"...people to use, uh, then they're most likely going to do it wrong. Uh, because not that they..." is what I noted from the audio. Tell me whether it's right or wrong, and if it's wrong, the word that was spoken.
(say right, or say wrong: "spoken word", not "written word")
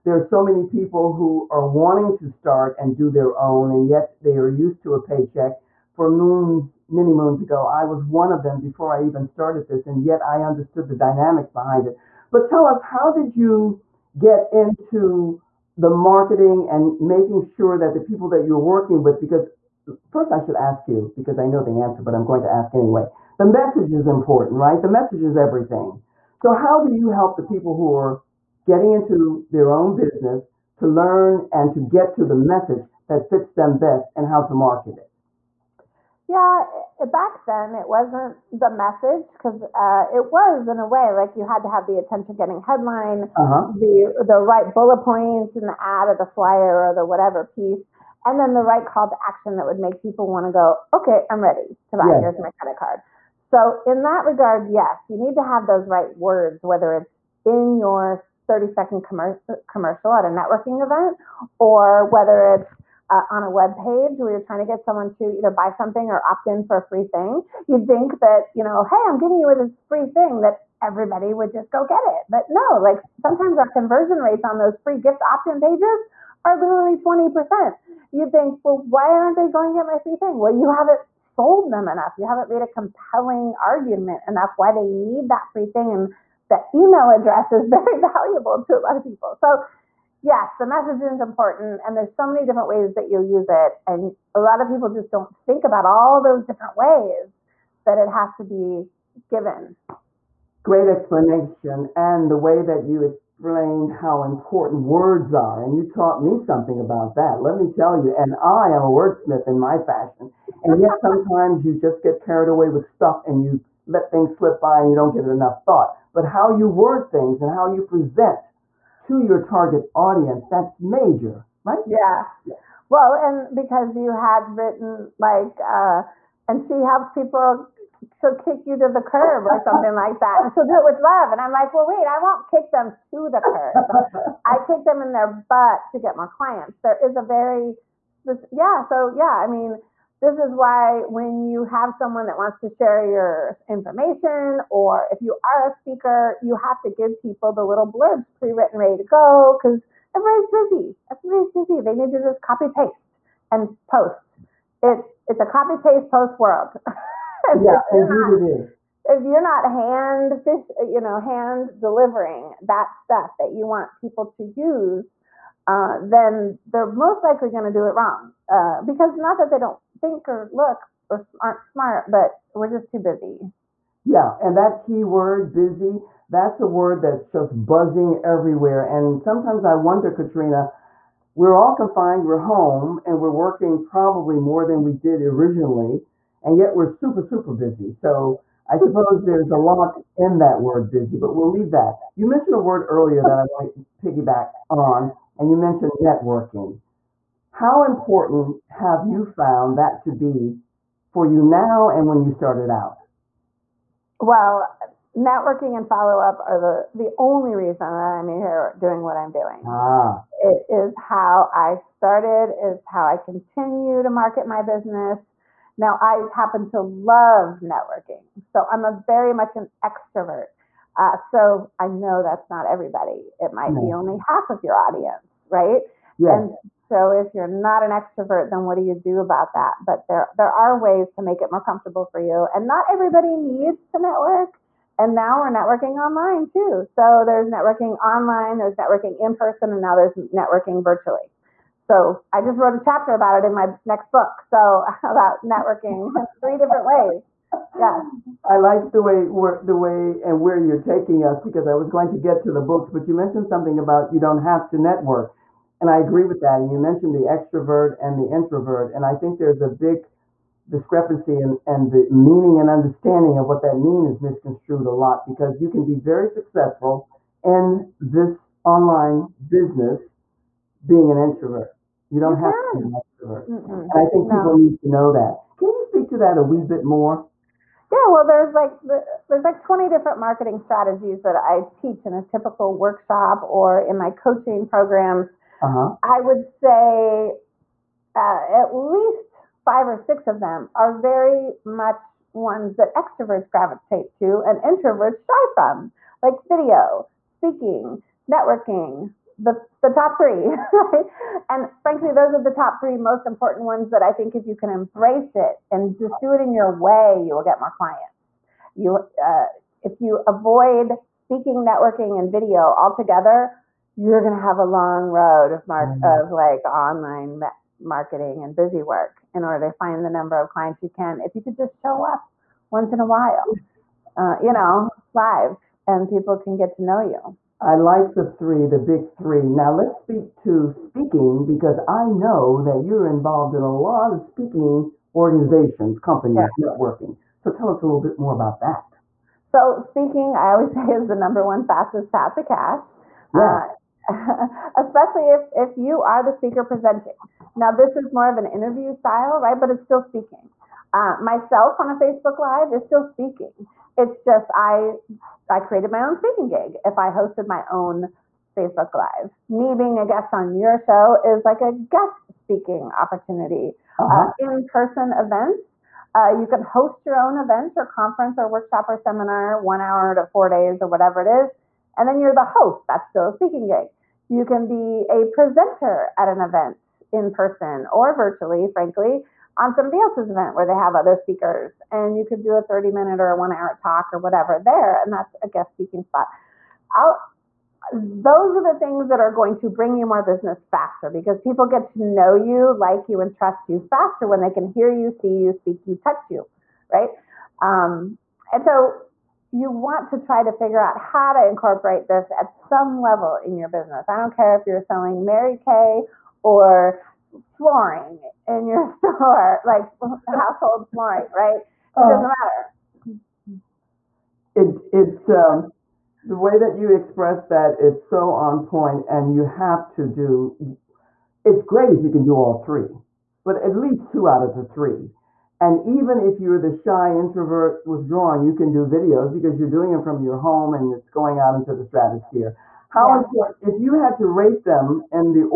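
right.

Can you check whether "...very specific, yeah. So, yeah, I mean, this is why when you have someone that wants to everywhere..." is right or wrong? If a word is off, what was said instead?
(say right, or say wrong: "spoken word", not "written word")
wrong: "share", not "everywhere".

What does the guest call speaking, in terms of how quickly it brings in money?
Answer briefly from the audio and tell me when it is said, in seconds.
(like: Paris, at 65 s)
fastest path to cash, at 341 s.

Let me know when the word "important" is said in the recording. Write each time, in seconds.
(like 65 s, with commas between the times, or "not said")
24 s, 91 s, 104 s, 197 s, 303 s, 433 s.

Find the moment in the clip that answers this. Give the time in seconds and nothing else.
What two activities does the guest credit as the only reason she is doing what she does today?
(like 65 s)
205 s.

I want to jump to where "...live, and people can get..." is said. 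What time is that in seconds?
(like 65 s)
325 s.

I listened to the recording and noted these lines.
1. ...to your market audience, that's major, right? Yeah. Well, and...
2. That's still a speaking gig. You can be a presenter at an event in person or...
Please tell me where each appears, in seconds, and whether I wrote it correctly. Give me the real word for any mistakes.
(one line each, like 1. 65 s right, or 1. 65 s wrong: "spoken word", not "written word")
1. 119 s wrong: "target", not "market"
2. 372 s right.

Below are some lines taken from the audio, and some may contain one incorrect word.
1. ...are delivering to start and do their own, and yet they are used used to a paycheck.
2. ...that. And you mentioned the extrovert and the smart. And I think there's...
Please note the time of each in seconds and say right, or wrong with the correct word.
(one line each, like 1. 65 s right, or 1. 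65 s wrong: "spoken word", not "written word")
1. 1 s wrong: "wanting", not "delivering"
2. 256 s wrong: "introvert", not "smart".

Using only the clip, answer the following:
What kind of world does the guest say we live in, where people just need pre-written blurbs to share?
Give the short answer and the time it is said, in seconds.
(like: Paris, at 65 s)
copy paste post world, at 155 s.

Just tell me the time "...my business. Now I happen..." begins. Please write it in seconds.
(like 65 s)
214 s.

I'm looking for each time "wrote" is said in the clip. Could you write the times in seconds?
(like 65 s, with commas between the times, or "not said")
242 s.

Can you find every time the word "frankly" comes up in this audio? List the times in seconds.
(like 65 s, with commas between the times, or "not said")
301 s, 378 s.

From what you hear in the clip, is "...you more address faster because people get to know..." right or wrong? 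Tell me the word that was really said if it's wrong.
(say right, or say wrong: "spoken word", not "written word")
wrong: "business", not "address".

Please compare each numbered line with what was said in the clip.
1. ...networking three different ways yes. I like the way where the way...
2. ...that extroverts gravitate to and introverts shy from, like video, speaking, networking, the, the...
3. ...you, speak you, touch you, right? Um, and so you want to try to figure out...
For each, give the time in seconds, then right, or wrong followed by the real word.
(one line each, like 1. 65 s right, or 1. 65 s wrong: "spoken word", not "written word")
1. 245 s right
2. 292 s right
3. 395 s right.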